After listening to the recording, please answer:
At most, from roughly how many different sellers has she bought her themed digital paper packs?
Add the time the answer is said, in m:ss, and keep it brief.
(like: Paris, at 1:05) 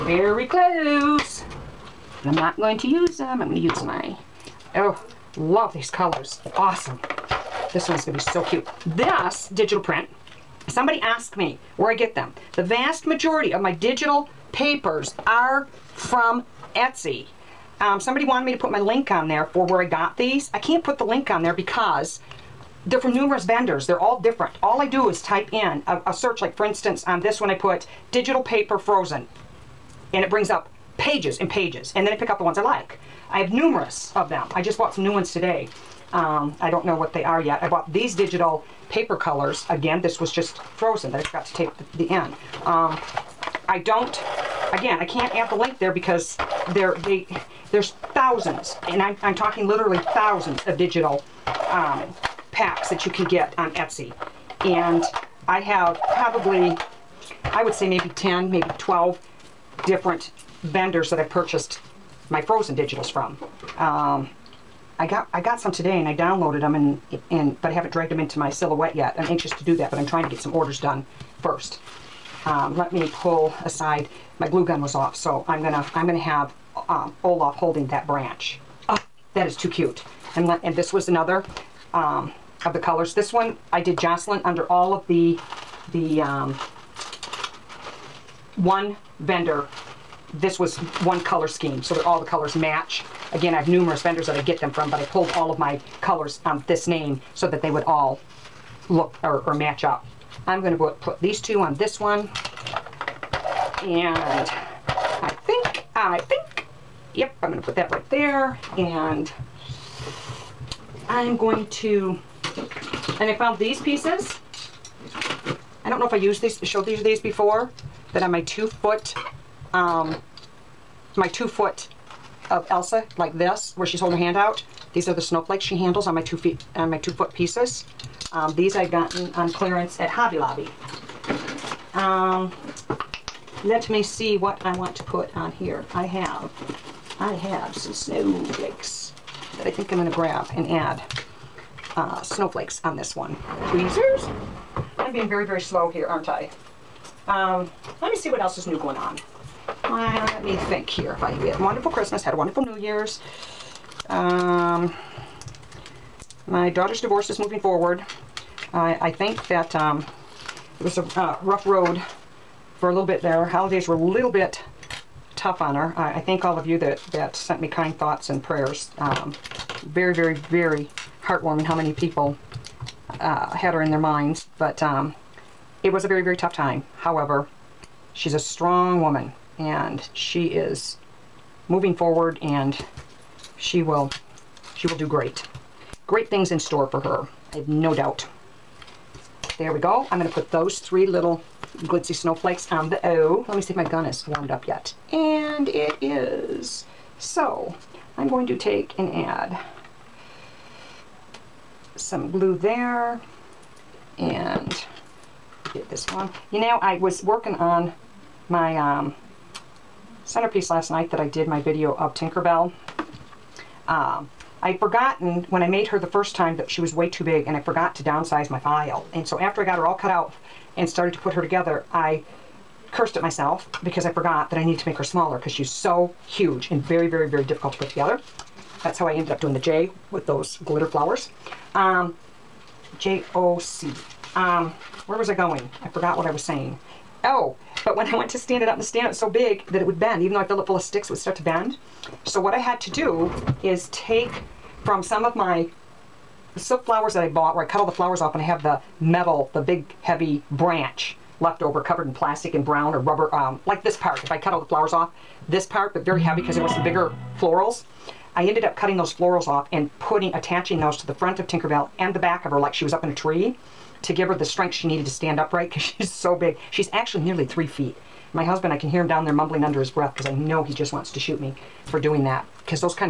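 12, at 0:58.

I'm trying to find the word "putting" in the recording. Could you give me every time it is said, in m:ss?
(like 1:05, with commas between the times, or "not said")
4:19.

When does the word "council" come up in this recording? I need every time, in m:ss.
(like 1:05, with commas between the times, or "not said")
not said.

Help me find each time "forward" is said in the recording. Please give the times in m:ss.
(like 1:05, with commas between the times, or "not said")
2:37, 3:01.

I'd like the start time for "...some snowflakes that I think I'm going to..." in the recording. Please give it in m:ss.
2:17.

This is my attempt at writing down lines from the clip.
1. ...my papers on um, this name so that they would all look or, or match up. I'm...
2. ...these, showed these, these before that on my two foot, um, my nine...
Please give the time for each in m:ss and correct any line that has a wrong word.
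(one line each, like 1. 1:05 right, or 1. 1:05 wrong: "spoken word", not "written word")
1. 1:35 wrong: "colors", not "papers"
2. 1:56 wrong: "two", not "nine".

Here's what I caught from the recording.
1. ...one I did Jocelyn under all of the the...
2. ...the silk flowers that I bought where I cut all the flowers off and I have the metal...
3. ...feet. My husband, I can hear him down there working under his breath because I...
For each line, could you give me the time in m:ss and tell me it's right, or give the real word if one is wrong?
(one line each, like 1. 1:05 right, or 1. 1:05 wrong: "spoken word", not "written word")
1. 1:23 right
2. 4:06 right
3. 4:27 wrong: "mumbling", not "working".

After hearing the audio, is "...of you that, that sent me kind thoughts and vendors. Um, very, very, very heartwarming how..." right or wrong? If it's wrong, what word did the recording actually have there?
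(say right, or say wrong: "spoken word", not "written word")
wrong: "prayers", not "vendors".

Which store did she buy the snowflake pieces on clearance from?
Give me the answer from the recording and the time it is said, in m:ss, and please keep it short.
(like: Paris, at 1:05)
Hobby Lobby, at 2:10.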